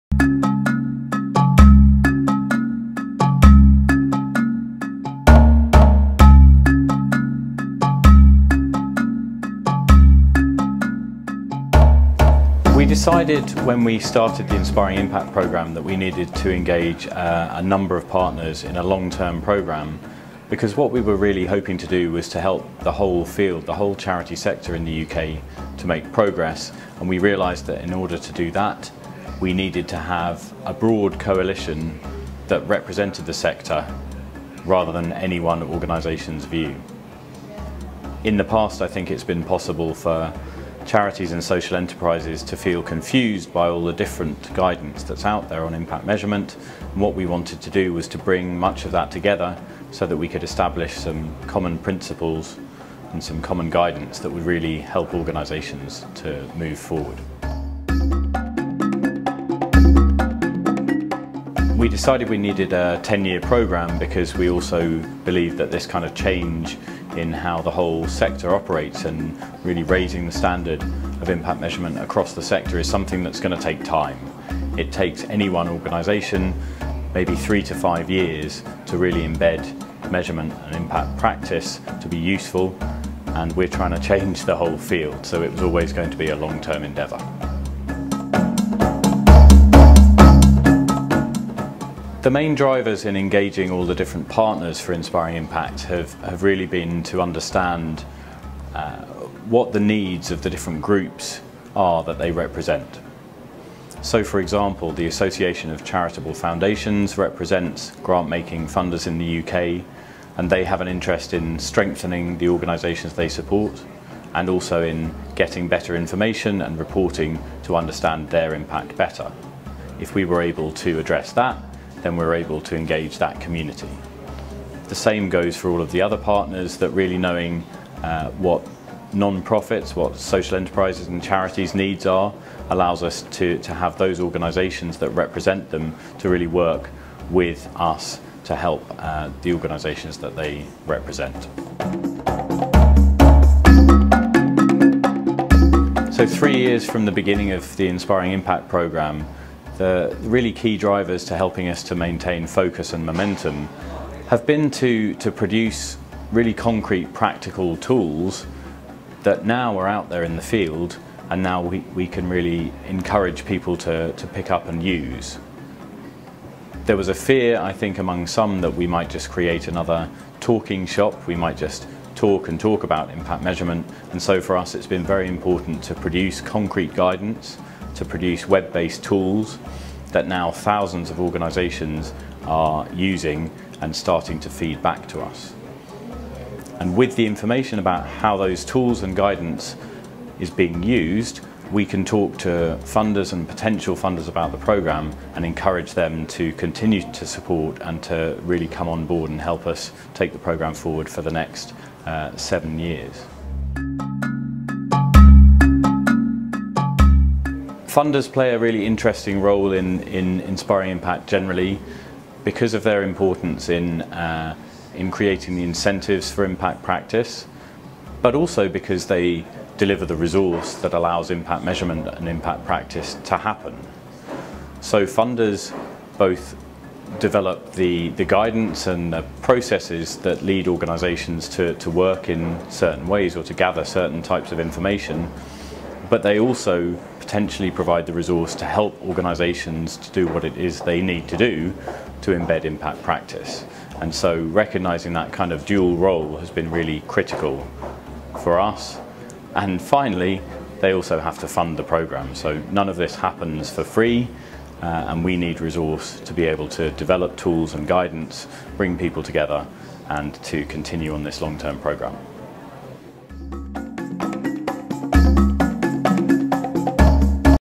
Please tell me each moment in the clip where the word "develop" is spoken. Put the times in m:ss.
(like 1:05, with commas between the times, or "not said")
3:47, 4:17.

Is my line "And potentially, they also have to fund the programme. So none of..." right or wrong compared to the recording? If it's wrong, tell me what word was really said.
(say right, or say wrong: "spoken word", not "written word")
wrong: "finally", not "potentially".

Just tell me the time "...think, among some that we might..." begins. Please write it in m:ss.
2:47.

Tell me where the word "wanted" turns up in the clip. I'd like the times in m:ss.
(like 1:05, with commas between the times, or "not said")
0:47.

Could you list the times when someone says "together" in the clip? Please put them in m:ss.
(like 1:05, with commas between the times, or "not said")
0:49, 4:19.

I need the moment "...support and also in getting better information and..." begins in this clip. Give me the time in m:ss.
1:53.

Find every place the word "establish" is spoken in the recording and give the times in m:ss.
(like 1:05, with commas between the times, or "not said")
0:50.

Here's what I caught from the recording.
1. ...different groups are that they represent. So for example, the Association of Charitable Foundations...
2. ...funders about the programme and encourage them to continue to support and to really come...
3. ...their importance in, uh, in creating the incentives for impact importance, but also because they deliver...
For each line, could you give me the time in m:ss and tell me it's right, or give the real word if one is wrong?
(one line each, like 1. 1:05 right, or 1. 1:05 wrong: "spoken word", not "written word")
1. 1:40 right
2. 3:13 right
3. 3:32 wrong: "practice", not "importance".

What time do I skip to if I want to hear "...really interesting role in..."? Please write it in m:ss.
3:28.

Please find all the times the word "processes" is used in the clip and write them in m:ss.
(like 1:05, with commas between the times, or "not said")
3:49.